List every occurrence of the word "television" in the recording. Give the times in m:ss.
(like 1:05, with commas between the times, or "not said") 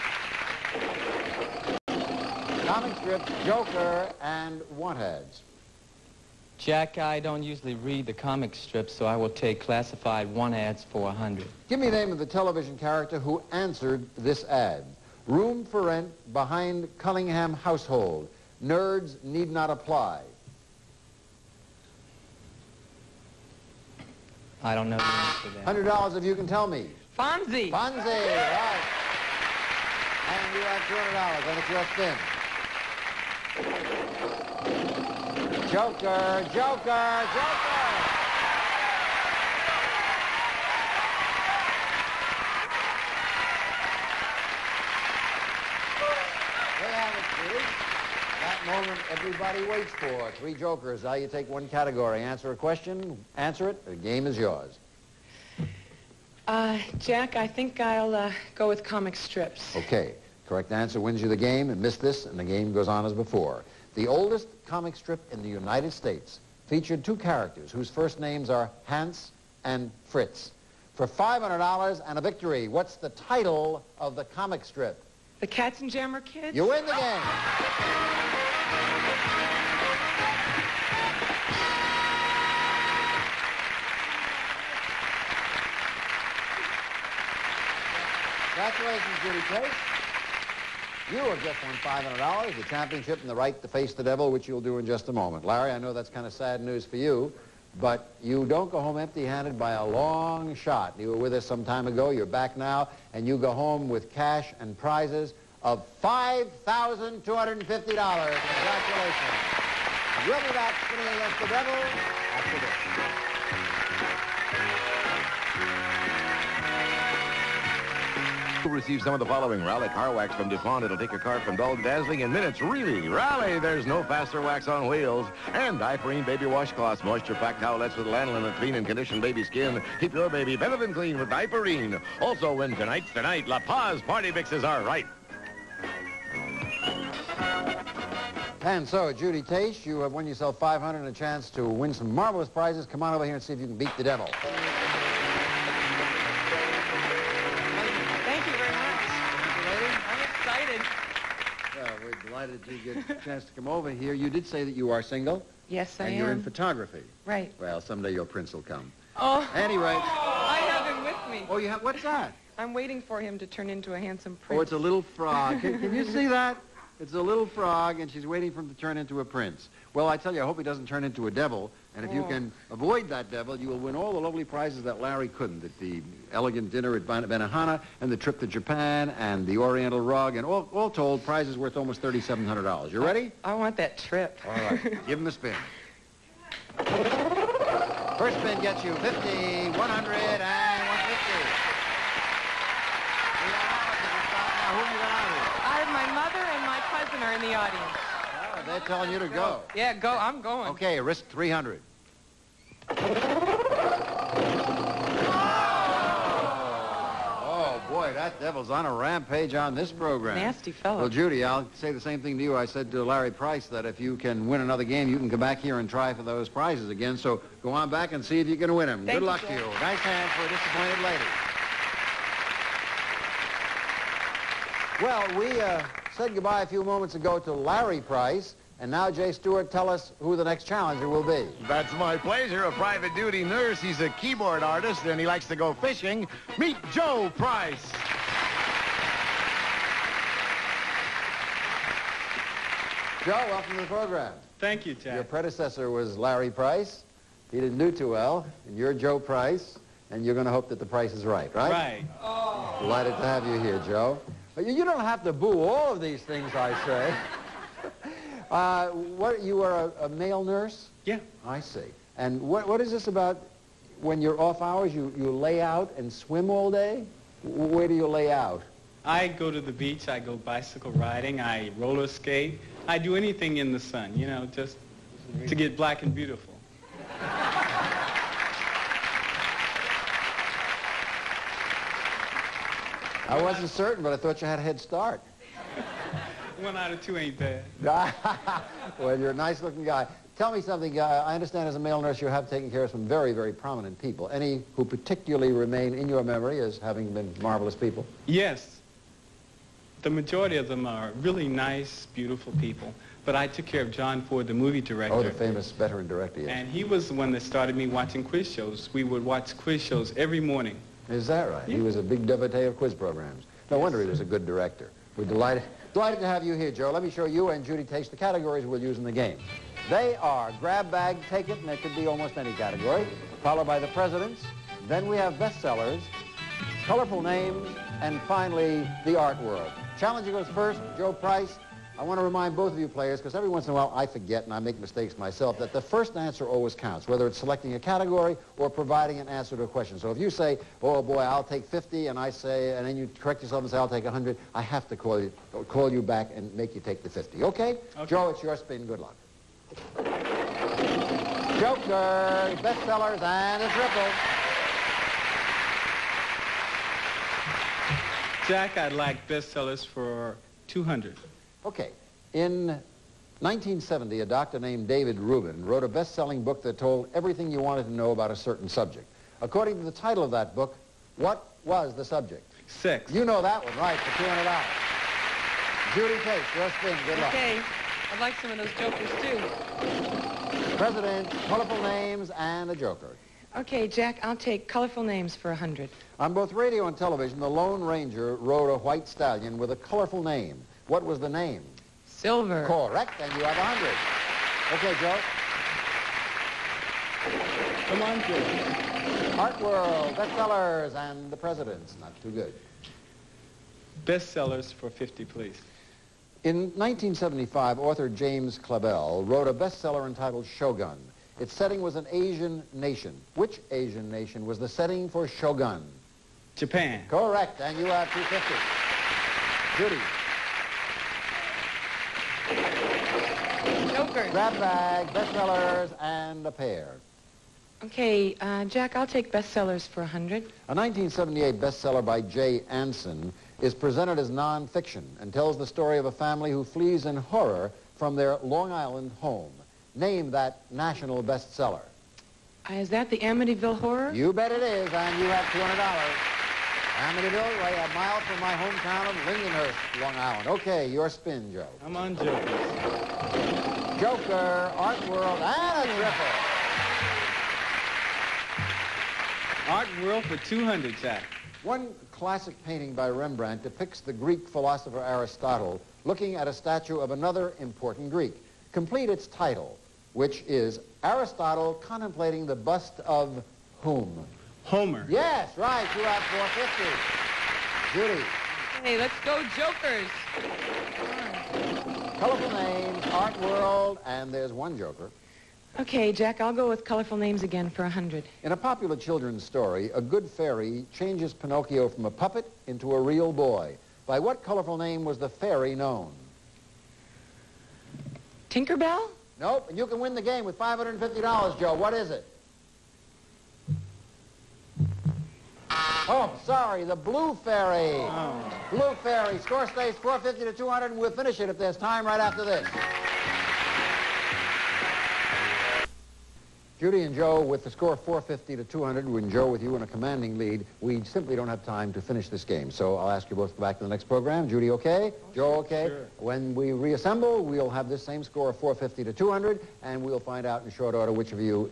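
0:12, 6:26.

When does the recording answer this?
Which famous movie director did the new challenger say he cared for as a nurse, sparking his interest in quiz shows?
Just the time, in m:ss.
5:03.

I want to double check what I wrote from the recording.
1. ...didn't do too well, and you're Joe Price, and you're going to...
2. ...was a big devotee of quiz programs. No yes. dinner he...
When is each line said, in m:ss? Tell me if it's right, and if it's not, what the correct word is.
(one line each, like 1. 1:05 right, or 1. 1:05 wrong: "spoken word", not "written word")
1. 4:07 right
2. 5:11 wrong: "wonder", not "dinner".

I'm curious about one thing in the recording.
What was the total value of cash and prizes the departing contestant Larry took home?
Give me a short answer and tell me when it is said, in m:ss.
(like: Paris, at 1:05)
$5,250, at 1:46.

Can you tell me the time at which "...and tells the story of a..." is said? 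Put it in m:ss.
7:15.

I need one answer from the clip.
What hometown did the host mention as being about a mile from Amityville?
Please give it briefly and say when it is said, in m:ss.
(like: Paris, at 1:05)
Lindenhurst, at 7:29.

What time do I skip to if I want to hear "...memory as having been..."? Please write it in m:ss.
4:56.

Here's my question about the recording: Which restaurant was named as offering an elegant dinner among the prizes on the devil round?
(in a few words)
Benihana.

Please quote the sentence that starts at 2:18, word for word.
And so, Judy Tate, you have won yourself 500 and a chance to win some marvelous prizes.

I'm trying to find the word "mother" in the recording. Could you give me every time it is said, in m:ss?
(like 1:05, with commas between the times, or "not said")
3:16.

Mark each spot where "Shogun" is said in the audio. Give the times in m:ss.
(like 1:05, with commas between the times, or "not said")
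6:50, 6:55.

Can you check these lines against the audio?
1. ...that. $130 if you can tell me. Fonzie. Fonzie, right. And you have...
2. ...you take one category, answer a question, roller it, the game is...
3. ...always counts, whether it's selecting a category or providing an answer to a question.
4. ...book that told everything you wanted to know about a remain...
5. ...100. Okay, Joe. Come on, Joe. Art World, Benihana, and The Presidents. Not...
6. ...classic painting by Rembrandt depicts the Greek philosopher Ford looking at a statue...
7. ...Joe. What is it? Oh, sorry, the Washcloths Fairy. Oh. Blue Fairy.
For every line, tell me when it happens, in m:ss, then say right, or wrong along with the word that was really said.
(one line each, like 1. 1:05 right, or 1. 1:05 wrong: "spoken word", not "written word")
1. 0:25 wrong: "100", not "130"
2. 0:51 wrong: "answer", not "roller"
3. 5:36 right
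4. 6:06 wrong: "certain", not "remain"
5. 6:33 wrong: "Bestsellers", not "Benihana"
6. 7:42 wrong: "Aristotle", not "Ford"
7. 8:21 wrong: "Blue", not "Washcloths".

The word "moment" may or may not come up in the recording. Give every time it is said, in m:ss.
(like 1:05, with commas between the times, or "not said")
0:48, 1:35, 3:46.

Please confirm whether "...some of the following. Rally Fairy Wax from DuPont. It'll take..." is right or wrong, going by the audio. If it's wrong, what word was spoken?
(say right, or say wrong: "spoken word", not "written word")
wrong: "Car", not "Fairy".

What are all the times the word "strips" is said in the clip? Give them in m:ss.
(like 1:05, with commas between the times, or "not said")
0:02, 0:08, 0:59, 1:04, 1:14.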